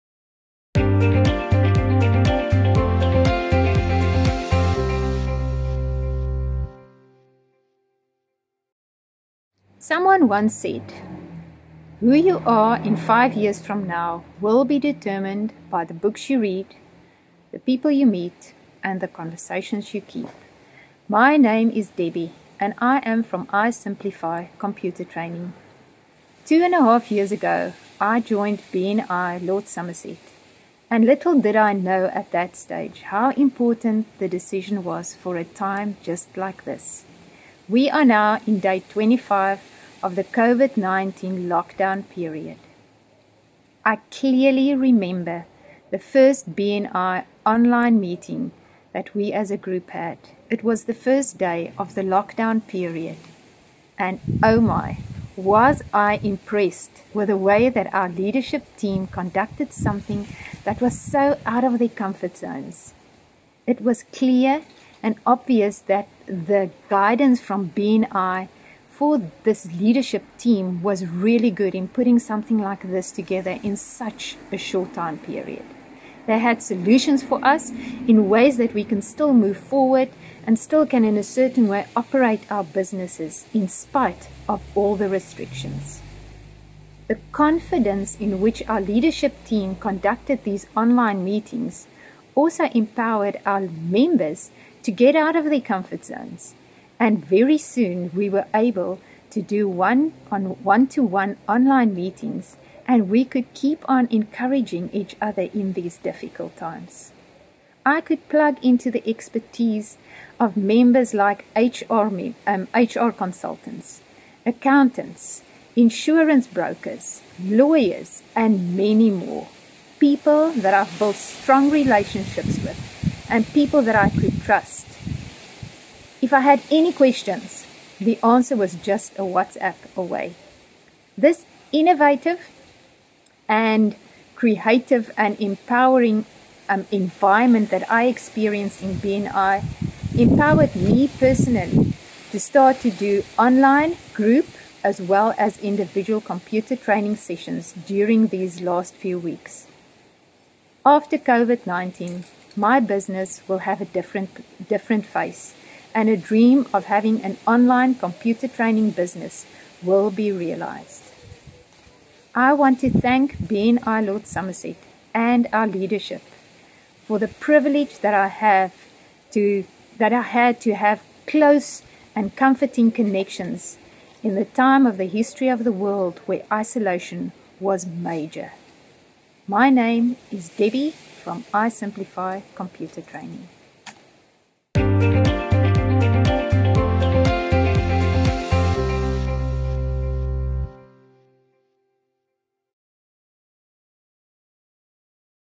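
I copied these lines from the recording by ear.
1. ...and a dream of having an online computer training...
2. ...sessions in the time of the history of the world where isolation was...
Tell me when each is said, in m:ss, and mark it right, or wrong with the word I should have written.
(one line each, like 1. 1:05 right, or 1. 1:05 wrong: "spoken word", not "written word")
1. 2:35 right
2. 2:52 wrong: "connections", not "sessions".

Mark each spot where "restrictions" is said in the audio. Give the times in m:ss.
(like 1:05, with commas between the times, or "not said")
1:25.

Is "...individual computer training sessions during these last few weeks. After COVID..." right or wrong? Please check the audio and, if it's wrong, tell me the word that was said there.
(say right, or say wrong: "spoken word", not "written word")
right.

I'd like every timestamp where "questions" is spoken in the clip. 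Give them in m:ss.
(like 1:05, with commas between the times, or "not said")
2:06.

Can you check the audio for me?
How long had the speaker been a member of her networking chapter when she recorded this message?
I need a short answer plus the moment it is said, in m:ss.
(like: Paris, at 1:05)
Two and a half years, at 0:26.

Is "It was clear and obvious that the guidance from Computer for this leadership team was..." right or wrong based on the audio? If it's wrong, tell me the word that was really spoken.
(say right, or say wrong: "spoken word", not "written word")
wrong: "BNI", not "Computer".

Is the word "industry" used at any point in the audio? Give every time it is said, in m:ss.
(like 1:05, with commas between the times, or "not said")
not said.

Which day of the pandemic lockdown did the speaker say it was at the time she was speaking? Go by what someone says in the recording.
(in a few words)
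Day 25.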